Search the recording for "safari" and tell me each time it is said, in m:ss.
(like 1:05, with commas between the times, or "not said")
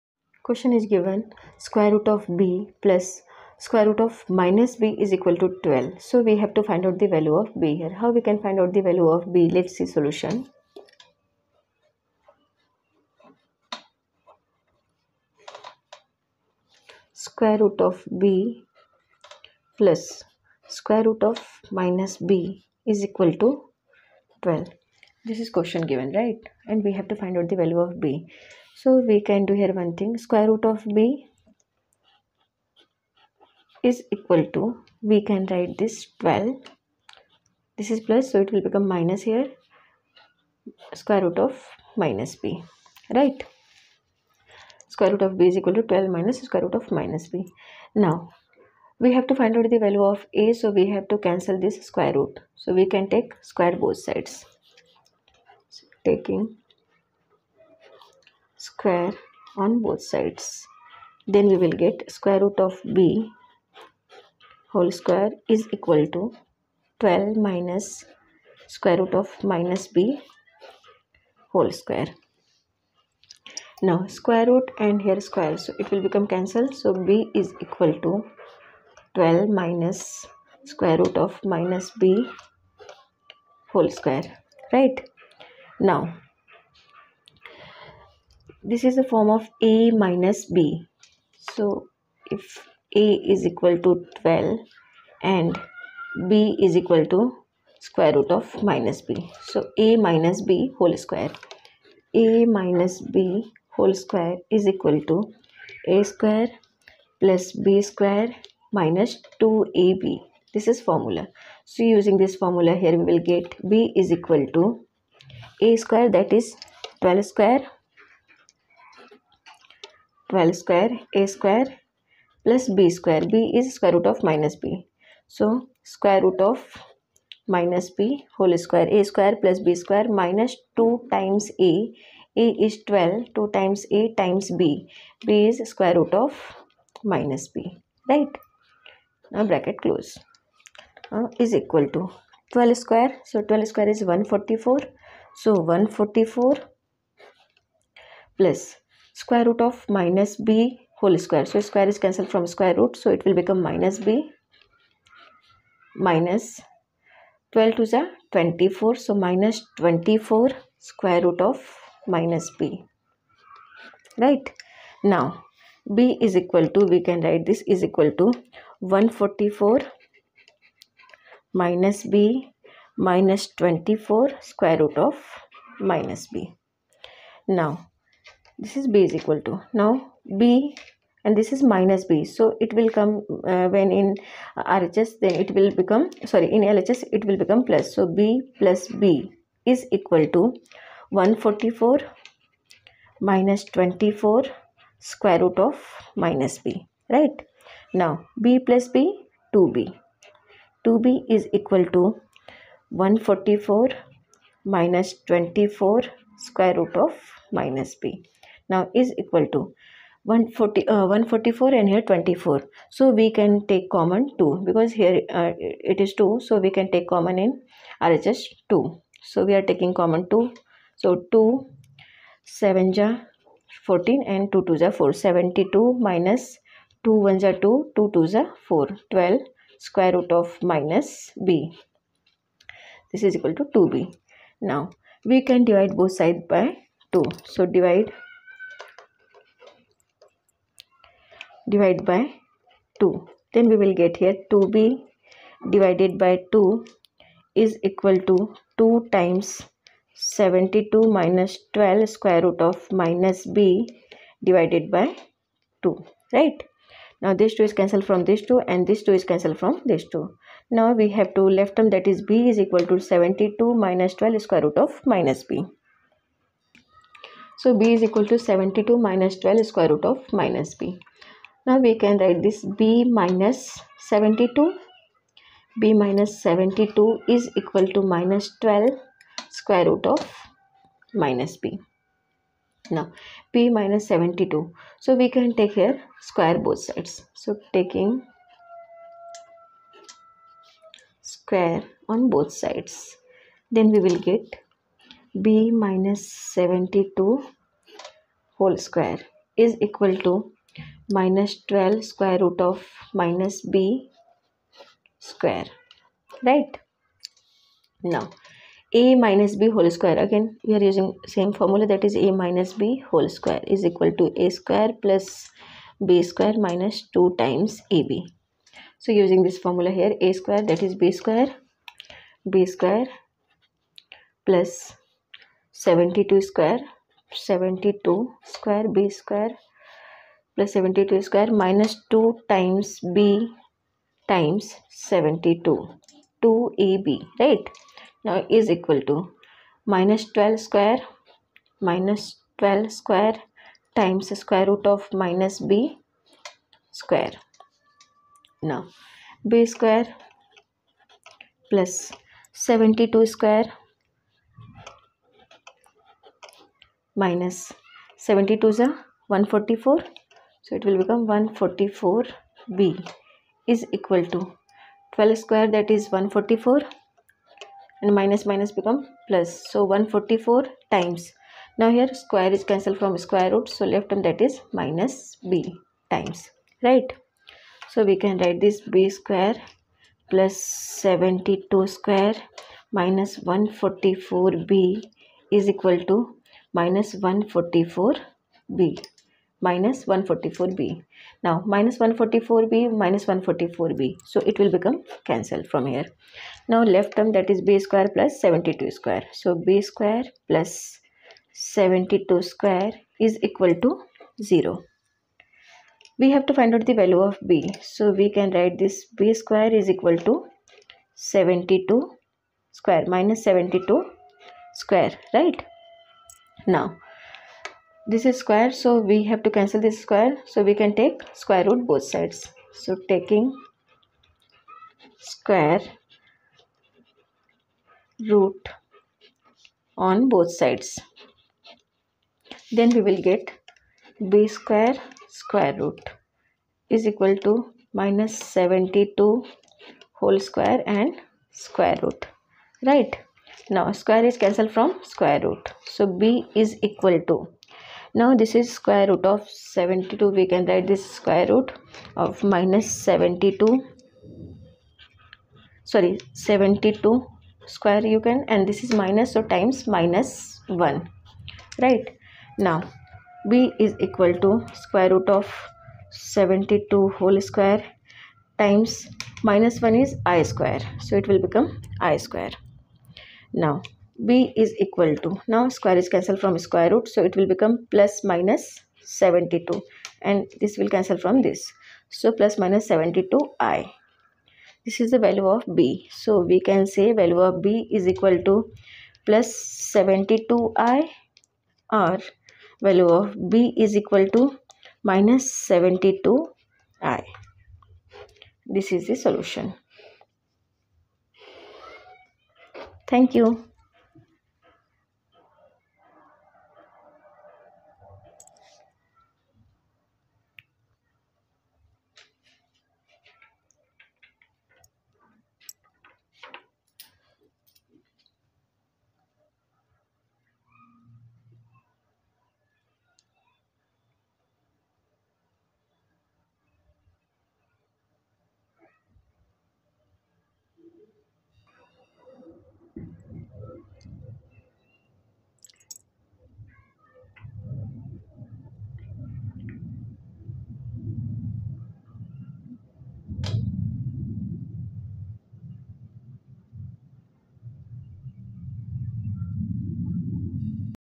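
not said.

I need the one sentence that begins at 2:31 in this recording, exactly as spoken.
So square is cancelled from square root.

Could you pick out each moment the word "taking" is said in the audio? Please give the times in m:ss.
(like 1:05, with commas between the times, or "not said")
0:56, 3:39, 4:47, 7:03.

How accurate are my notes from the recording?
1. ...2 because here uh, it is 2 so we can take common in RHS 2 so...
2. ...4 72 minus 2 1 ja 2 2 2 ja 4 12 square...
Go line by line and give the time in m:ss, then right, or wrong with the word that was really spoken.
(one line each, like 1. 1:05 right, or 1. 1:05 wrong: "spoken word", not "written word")
1. 3:34 right
2. 3:45 right.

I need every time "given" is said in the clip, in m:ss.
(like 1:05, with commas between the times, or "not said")
0:00, 0:25.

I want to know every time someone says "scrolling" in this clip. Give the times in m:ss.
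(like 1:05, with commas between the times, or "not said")
not said.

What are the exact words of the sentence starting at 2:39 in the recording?
So minus 24 square root of minus b.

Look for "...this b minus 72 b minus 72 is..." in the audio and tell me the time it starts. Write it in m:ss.
4:32.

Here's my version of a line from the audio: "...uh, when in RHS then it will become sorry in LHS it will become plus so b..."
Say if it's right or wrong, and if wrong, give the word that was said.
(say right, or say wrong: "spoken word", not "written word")
right.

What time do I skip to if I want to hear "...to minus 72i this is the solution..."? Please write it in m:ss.
8:14.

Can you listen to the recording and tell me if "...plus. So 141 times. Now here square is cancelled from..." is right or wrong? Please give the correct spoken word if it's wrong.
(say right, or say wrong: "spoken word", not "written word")
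wrong: "144", not "141".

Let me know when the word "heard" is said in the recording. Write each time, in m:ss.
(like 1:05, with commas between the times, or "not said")
not said.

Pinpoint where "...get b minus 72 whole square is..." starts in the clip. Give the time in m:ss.
4:54.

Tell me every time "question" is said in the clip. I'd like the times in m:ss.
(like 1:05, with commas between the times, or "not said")
0:00, 0:25.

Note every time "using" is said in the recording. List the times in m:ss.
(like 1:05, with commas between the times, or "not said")
1:51, 5:10, 5:19.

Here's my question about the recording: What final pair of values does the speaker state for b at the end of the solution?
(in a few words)
±72i.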